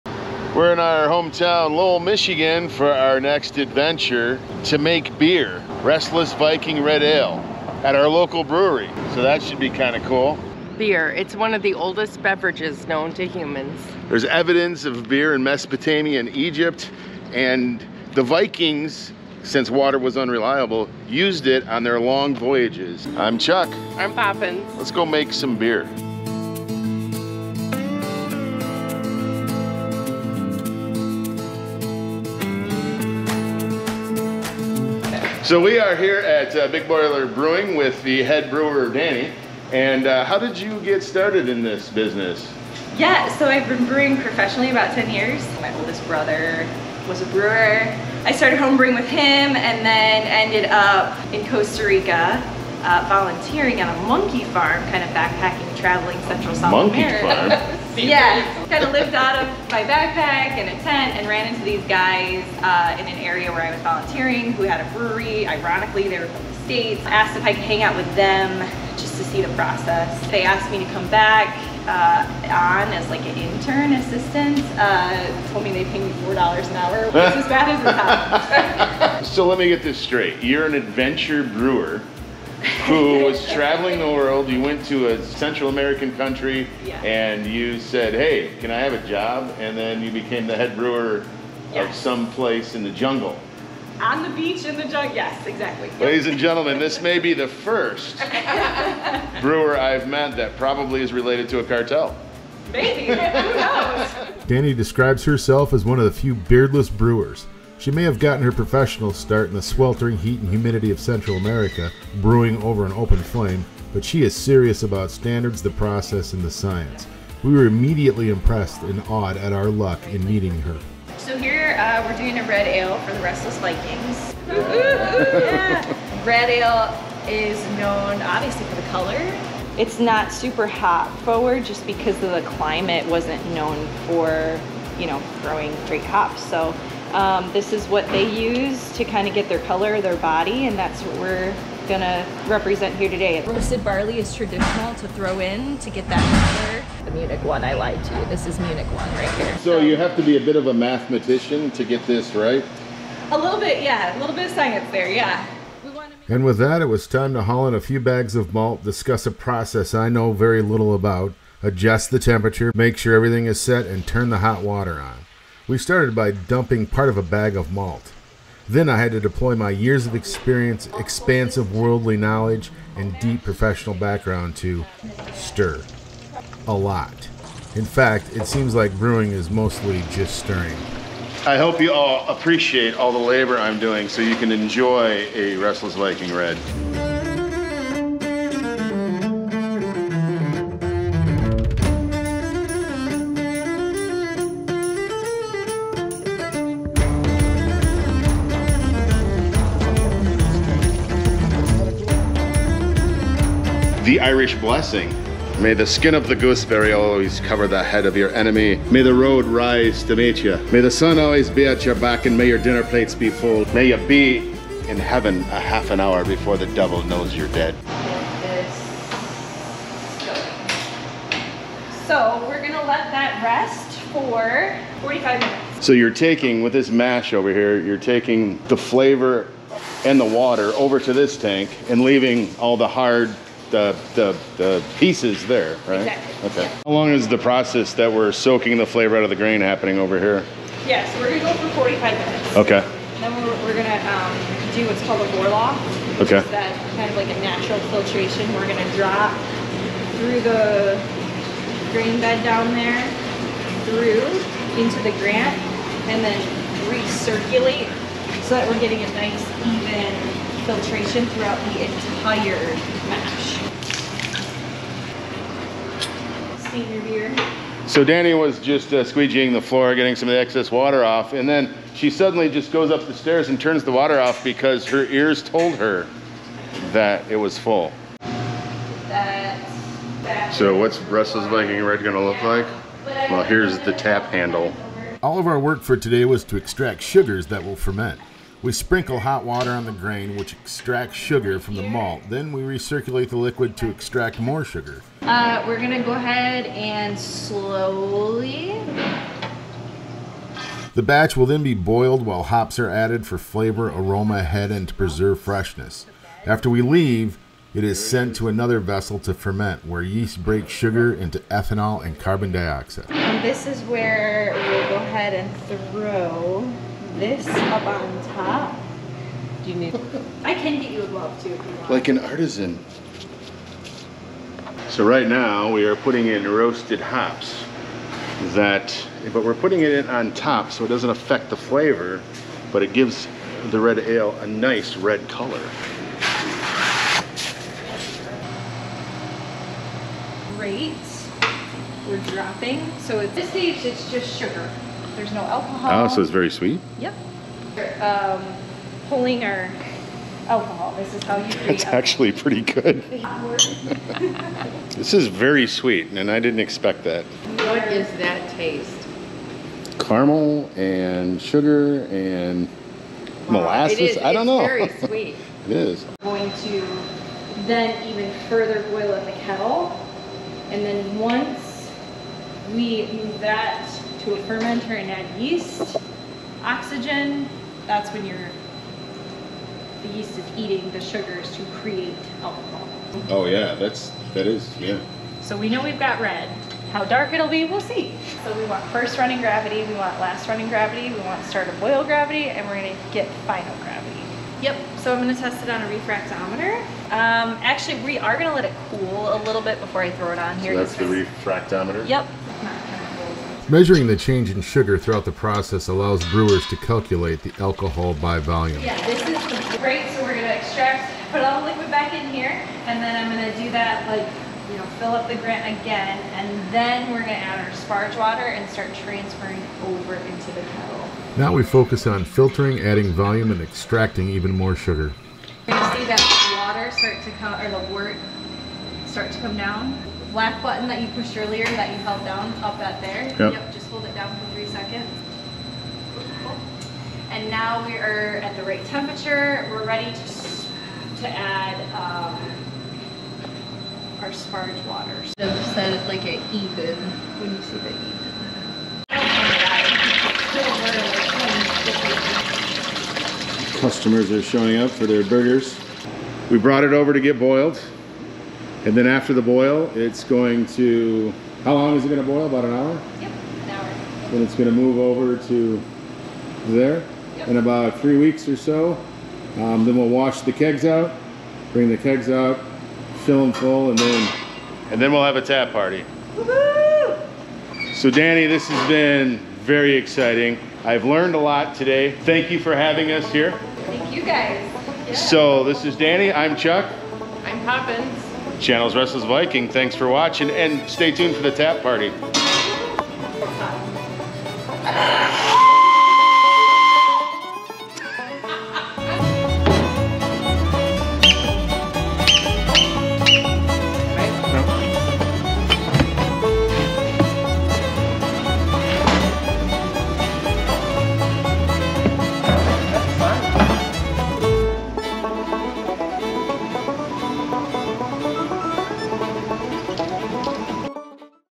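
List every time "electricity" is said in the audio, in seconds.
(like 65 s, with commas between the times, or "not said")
not said.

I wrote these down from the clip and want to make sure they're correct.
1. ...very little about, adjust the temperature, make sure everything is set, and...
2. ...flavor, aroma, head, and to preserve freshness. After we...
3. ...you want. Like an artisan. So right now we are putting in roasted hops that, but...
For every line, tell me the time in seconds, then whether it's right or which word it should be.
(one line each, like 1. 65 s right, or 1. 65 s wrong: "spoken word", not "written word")
1. 160 s right
2. 303 s right
3. 321 s right.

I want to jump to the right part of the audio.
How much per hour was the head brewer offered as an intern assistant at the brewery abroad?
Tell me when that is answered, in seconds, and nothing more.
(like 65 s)
76 s.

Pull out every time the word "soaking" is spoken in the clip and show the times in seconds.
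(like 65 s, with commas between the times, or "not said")
238 s.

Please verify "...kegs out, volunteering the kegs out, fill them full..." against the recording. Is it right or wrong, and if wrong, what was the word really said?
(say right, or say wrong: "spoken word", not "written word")
wrong: "bring", not "volunteering".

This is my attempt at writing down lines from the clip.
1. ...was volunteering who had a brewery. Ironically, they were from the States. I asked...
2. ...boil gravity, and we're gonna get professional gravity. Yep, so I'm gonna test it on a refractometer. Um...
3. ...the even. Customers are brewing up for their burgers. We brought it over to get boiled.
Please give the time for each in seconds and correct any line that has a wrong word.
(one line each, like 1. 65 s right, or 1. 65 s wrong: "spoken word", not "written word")
1. 63 s right
2. 391 s wrong: "final", not "professional"
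3. 447 s wrong: "showing", not "brewing".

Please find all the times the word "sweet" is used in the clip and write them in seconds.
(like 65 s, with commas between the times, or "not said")
346 s, 355 s, 364 s.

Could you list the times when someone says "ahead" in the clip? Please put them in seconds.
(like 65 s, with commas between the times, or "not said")
296 s, 314 s.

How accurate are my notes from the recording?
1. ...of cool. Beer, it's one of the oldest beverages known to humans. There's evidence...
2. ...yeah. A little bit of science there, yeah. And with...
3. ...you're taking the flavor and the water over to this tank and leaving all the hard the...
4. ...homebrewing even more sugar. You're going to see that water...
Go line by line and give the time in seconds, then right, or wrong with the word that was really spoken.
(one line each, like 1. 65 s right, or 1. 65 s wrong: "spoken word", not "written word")
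1. 9 s right
2. 153 s right
3. 227 s right
4. 423 s wrong: "extracting", not "homebrewing".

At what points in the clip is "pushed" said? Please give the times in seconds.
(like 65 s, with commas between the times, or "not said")
431 s.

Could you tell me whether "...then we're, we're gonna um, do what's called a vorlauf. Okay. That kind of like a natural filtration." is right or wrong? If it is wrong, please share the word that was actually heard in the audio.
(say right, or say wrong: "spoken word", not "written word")
right.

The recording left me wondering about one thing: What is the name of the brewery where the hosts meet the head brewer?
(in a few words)
Big Boiler Brewing.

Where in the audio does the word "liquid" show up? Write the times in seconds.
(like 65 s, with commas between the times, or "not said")
293 s, 411 s.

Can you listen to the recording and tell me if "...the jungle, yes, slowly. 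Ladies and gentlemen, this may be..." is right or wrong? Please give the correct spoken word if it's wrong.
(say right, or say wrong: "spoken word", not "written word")
wrong: "exactly", not "slowly".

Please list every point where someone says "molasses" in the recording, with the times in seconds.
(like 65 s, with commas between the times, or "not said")
363 s.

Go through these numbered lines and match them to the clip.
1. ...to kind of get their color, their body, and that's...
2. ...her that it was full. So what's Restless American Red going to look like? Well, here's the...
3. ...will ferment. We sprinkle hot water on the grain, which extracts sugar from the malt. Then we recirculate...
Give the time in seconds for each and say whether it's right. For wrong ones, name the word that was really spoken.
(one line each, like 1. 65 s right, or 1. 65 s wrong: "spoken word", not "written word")
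1. 138 s right
2. 275 s wrong: "Viking", not "American"
3. 287 s right.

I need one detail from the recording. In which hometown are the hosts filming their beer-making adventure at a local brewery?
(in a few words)
Lowell, Michigan.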